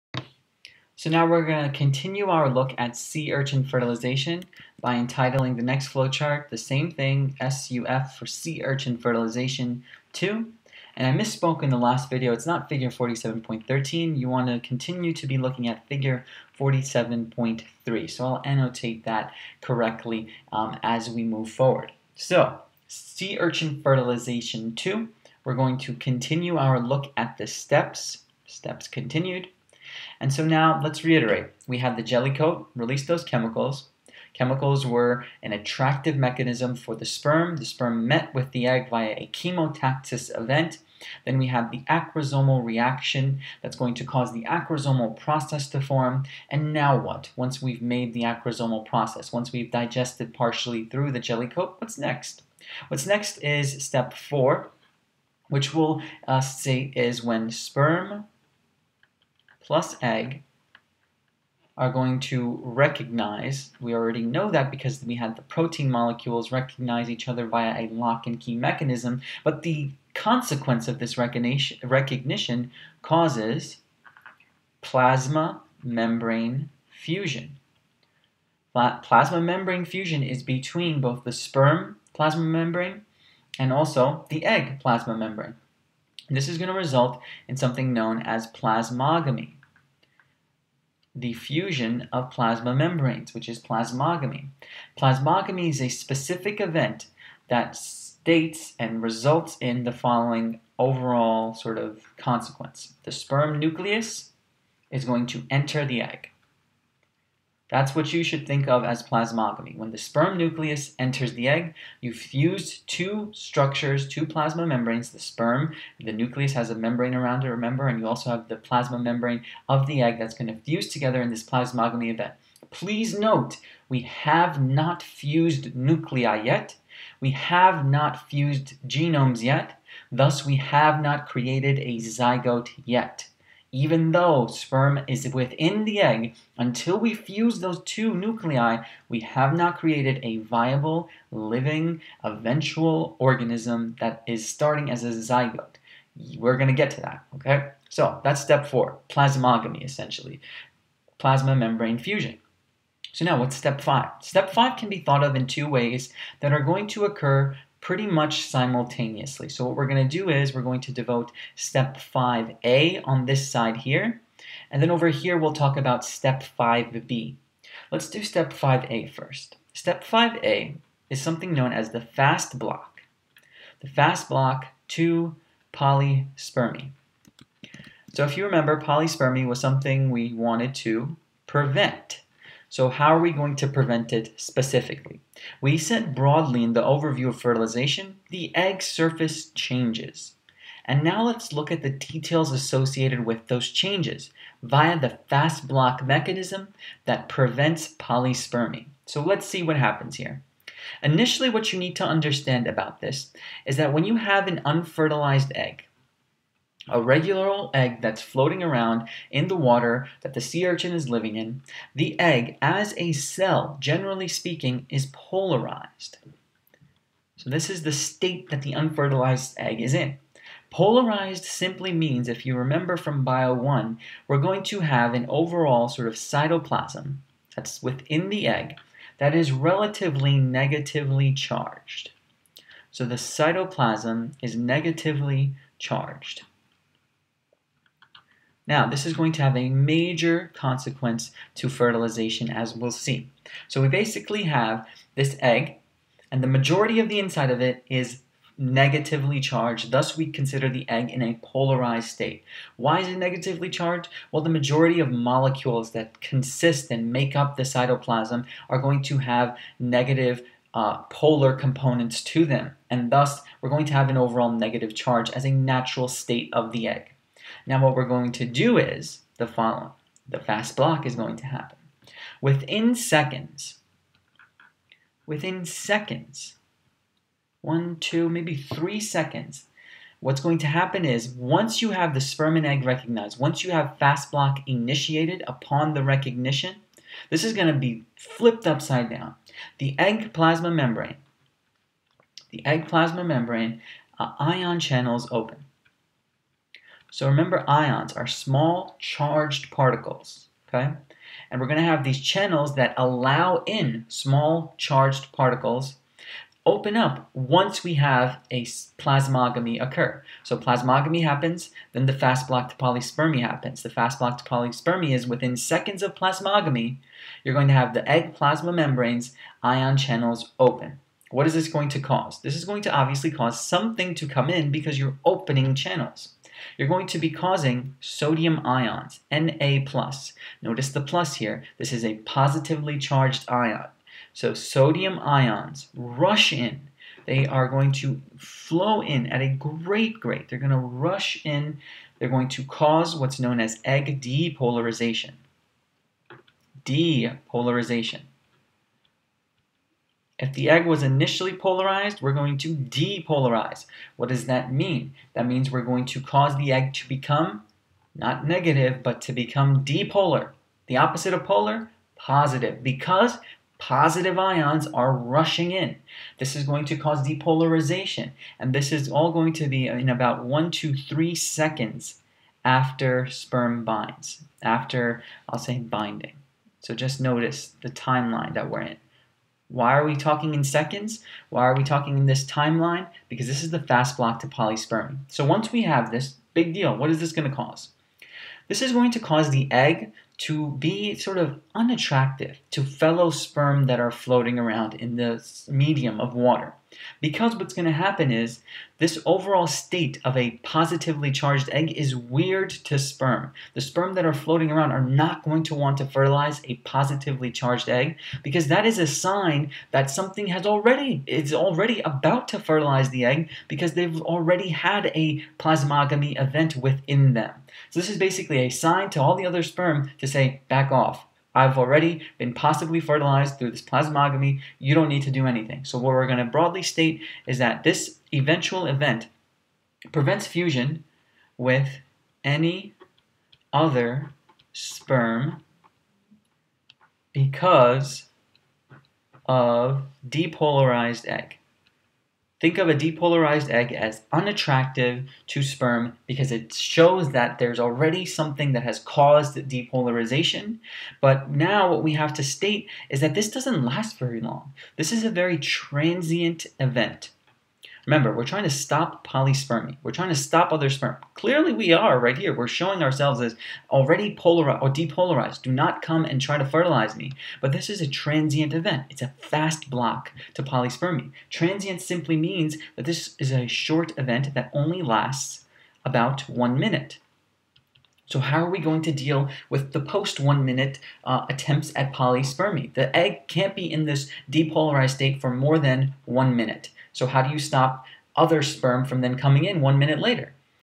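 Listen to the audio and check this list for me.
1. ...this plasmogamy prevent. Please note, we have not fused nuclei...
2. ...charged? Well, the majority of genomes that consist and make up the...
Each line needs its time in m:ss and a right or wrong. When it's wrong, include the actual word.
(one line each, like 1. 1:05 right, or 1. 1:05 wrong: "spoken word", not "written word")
1. 2:01 wrong: "event", not "prevent"
2. 4:13 wrong: "molecules", not "genomes".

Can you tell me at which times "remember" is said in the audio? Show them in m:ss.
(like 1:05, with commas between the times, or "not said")
1:57, 2:58, 3:42, 4:57, 7:38.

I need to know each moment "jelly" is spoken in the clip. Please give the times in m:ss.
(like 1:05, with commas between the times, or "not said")
0:32, 0:51.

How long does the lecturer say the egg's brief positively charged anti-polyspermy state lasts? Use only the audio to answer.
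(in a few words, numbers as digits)
About 1 minute.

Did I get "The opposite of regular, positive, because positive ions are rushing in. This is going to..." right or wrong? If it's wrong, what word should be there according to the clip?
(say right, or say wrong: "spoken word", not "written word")
wrong: "polar", not "regular".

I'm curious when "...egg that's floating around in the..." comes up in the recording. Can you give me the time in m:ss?
3:27.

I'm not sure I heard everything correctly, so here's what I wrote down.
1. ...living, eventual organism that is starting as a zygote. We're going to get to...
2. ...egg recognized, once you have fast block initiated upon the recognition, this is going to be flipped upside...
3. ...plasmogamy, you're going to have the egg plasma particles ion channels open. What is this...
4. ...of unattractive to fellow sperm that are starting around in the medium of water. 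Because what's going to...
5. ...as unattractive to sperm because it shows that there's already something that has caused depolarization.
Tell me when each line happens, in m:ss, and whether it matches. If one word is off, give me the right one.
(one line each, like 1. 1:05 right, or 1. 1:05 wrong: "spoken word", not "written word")
1. 2:21 right
2. 4:42 right
3. 5:16 wrong: "membranes", not "particles"
4. 6:31 wrong: "floating", not "starting"
5. 7:23 right.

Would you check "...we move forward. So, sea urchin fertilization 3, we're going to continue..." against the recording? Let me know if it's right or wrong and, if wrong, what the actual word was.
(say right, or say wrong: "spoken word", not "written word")
wrong: "2", not "3".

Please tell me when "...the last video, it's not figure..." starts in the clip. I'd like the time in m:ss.
0:11.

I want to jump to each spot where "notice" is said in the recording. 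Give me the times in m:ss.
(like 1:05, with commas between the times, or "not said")
5:30, 6:17.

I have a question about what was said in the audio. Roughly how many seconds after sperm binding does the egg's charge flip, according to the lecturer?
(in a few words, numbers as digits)
1 to 3 seconds.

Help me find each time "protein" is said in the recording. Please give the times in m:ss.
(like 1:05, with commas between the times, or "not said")
1:05.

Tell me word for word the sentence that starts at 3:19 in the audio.
So let's see what happens here.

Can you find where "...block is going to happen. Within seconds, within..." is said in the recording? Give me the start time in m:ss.
4:30.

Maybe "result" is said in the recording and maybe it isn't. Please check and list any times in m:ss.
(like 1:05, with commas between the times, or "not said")
1:26, 1:39.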